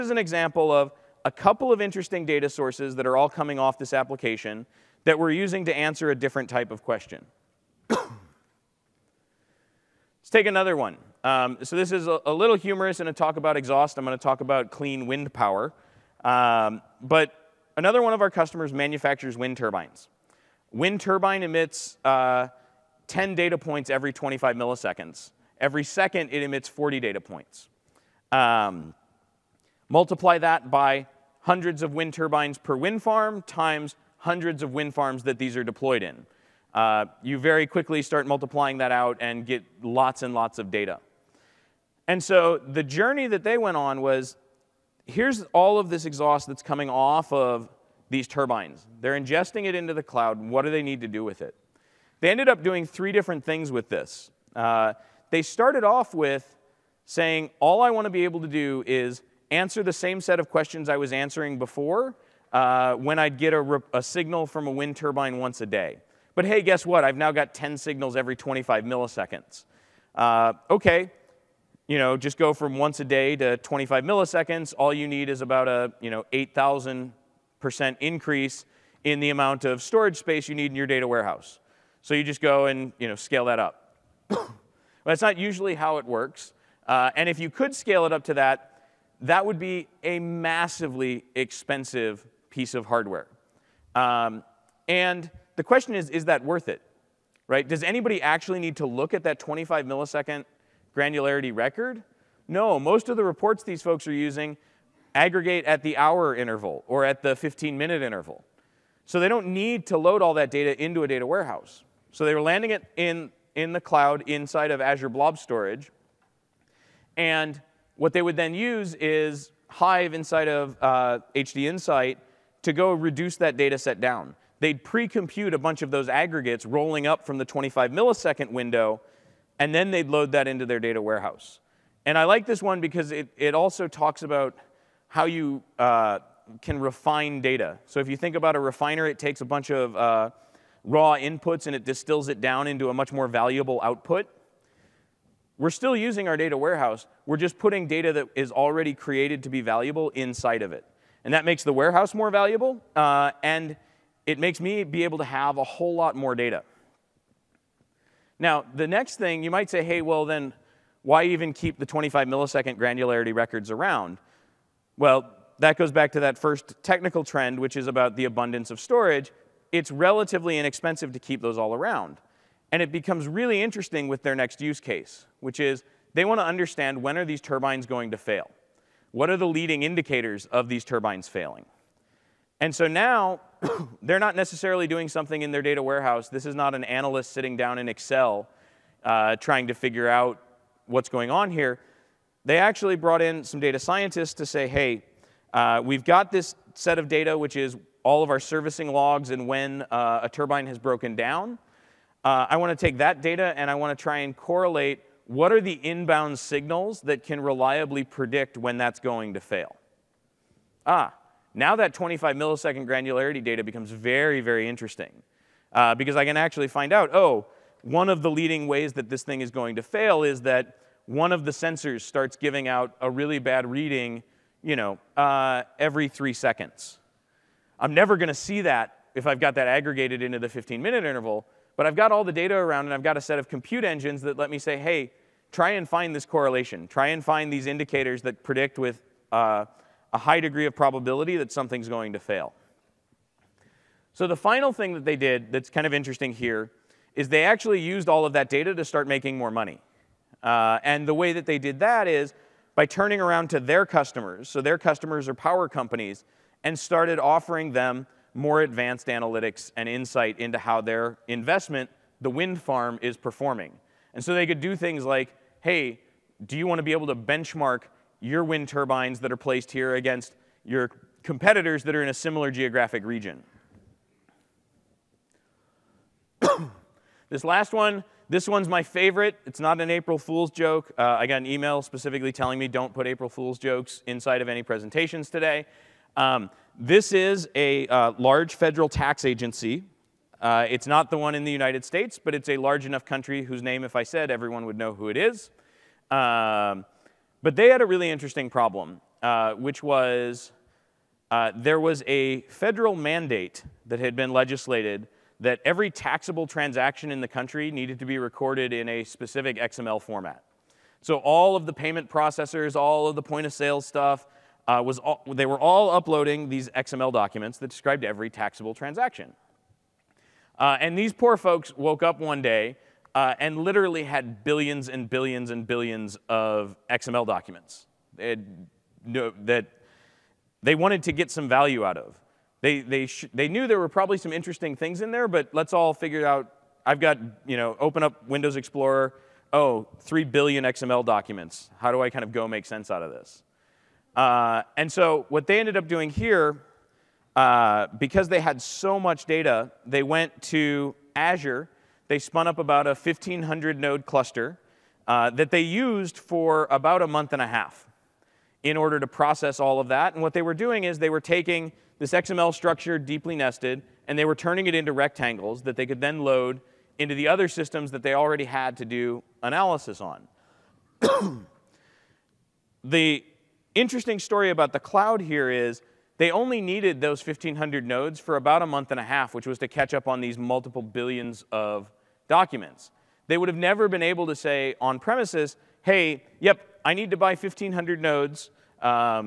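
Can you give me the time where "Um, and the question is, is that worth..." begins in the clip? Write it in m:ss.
1:33.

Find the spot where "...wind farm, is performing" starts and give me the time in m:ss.
4:22.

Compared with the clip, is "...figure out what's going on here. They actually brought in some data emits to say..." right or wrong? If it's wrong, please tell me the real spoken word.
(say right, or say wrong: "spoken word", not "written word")
wrong: "scientists", not "emits".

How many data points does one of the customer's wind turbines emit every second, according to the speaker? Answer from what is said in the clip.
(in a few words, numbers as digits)
40.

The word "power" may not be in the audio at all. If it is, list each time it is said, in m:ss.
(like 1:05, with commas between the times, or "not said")
0:15, 4:15.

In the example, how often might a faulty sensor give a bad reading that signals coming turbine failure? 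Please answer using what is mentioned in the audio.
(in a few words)
every three seconds.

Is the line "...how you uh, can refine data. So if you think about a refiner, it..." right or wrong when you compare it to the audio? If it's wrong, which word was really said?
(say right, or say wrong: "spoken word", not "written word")
right.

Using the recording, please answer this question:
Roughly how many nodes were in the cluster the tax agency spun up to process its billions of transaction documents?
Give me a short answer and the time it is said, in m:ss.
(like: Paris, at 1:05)
1,500, at 5:52.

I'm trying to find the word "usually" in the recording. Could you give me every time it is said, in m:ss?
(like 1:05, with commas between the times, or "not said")
1:25.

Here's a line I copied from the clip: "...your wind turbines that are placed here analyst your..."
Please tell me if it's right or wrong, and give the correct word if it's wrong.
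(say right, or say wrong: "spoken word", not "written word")
wrong: "against", not "analyst".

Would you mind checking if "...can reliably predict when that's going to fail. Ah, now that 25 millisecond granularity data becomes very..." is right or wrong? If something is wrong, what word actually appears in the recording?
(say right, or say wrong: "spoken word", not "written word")
right.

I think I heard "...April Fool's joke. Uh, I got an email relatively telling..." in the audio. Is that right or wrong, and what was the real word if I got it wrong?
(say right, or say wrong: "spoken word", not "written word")
wrong: "specifically", not "relatively".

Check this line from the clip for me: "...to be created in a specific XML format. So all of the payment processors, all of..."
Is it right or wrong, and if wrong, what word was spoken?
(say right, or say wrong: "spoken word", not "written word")
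wrong: "recorded", not "created".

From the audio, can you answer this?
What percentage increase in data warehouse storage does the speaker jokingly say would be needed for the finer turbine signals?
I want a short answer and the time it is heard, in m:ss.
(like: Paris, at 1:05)
8,000%, at 1:16.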